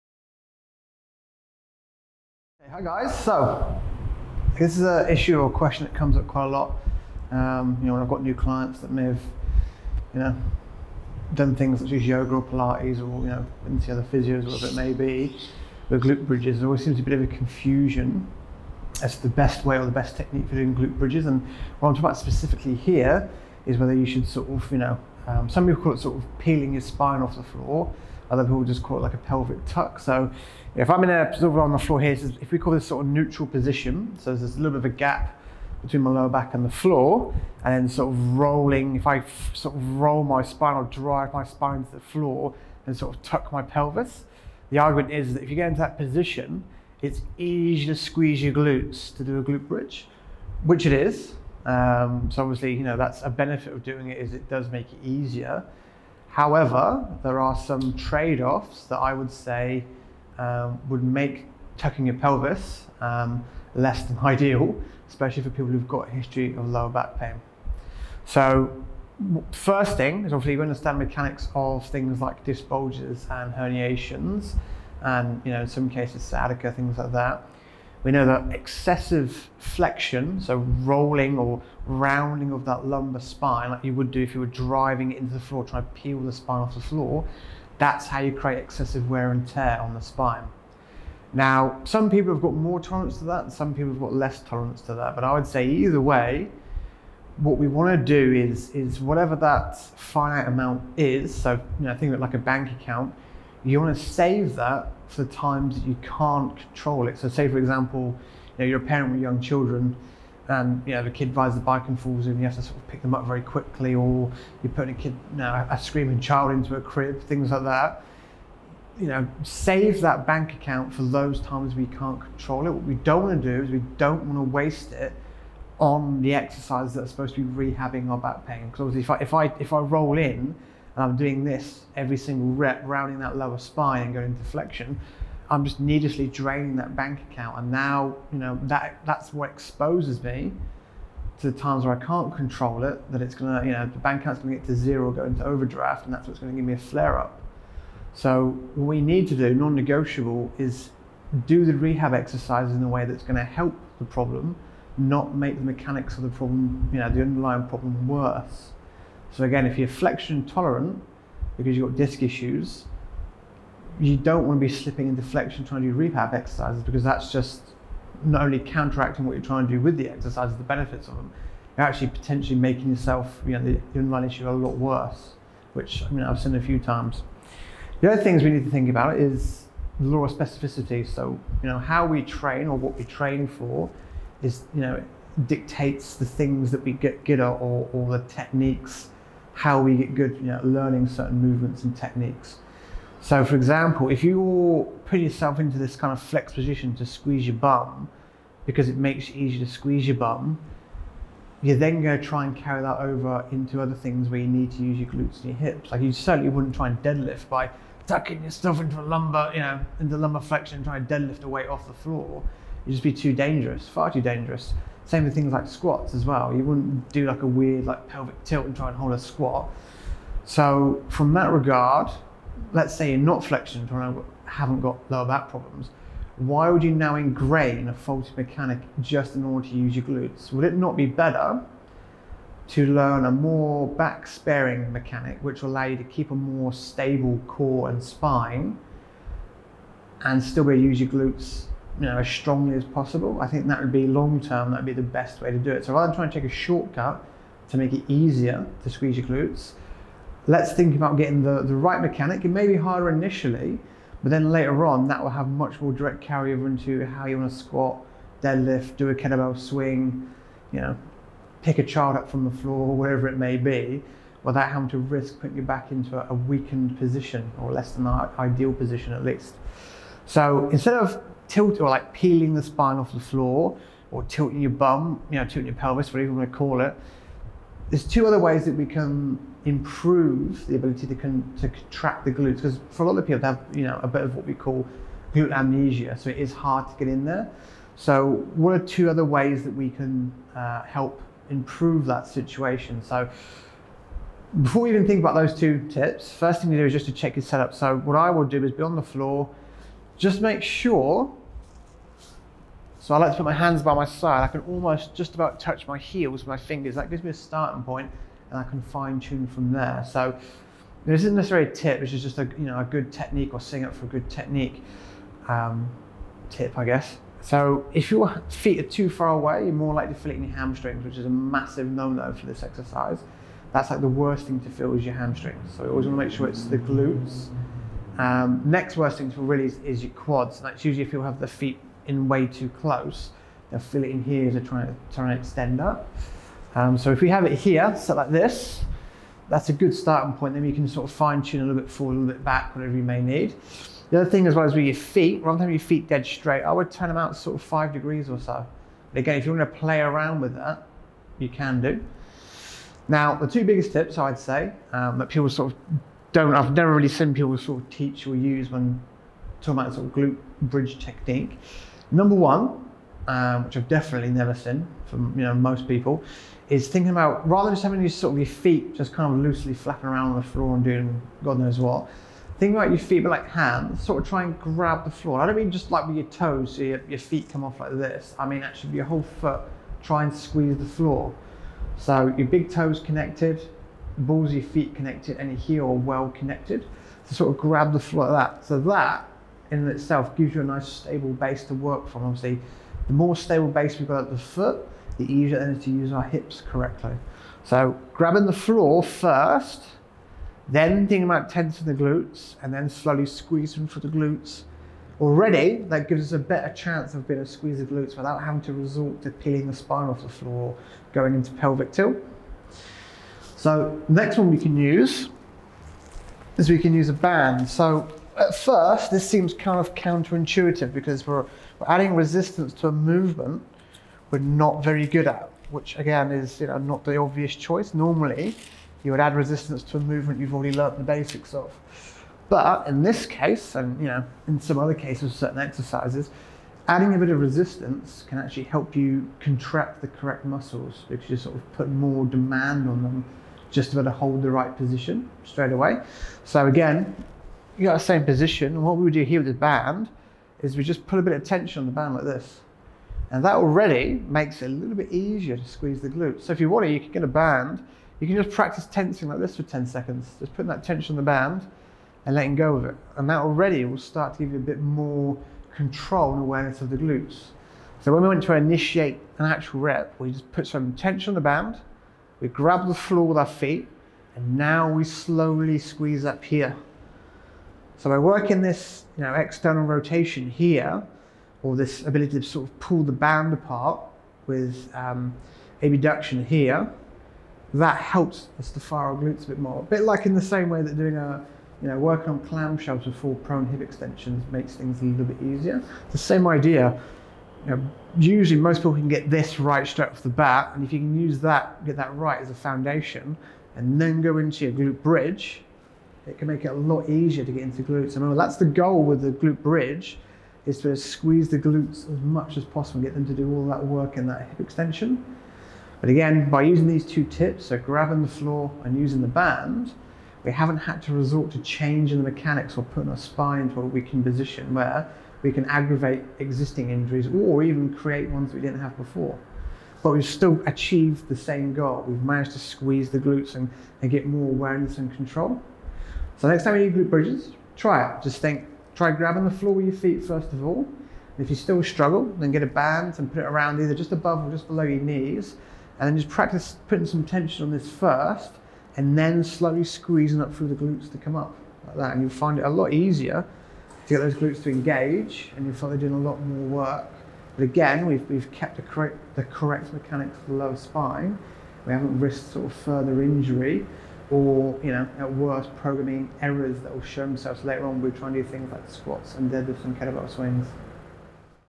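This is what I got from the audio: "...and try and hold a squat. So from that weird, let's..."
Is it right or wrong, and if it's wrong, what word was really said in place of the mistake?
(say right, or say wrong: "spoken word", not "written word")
wrong: "regard", not "weird".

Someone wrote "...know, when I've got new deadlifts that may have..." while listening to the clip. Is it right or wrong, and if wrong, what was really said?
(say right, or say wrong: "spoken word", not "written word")
wrong: "clients", not "deadlifts".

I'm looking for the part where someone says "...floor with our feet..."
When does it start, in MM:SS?
07:52.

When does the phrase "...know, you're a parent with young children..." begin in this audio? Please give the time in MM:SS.
01:48.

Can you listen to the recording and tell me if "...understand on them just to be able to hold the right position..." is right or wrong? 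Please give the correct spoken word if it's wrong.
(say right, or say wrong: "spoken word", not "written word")
wrong: "demand", not "understand".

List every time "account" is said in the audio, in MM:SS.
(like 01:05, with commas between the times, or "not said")
01:42, 02:00, 02:17, 02:24.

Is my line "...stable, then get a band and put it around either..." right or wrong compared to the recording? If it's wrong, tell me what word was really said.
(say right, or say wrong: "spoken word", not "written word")
wrong: "struggle", not "stable".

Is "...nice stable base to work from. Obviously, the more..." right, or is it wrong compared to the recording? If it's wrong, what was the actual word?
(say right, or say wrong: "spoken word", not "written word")
right.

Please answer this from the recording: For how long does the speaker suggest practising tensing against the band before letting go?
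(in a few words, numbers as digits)
10 seconds.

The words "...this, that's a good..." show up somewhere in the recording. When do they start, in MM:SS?
05:38.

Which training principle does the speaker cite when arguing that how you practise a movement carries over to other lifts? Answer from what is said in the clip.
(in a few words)
law of specificity.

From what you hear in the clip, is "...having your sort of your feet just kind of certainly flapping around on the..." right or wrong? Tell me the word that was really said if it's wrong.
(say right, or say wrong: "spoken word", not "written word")
wrong: "loosely", not "certainly".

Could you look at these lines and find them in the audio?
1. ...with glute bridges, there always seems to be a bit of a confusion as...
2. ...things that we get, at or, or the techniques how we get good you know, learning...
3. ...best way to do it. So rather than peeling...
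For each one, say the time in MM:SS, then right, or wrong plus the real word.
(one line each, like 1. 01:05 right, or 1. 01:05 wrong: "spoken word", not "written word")
1. 00:15 right
2. 03:06 right
3. 04:05 wrong: "trying", not "peeling".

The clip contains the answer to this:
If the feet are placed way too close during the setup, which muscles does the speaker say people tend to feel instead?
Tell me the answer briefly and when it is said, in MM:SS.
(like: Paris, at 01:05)
quads, at 05:30.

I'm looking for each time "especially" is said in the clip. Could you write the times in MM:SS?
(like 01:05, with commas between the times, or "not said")
01:05.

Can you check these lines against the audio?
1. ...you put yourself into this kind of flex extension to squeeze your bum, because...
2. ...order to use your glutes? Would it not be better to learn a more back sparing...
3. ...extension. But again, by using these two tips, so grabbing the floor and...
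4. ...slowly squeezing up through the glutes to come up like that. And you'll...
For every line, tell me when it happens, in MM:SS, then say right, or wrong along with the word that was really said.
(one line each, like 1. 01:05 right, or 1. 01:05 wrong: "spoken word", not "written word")
1. 03:14 wrong: "position", not "extension"
2. 03:49 right
3. 08:34 right
4. 09:09 right.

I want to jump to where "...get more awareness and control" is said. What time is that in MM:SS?
08:54.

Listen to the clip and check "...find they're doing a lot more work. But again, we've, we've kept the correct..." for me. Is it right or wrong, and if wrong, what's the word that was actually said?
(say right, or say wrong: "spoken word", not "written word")
right.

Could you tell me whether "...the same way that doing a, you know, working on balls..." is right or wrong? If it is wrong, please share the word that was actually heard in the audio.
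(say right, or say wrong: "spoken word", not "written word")
wrong: "clamshells", not "balls".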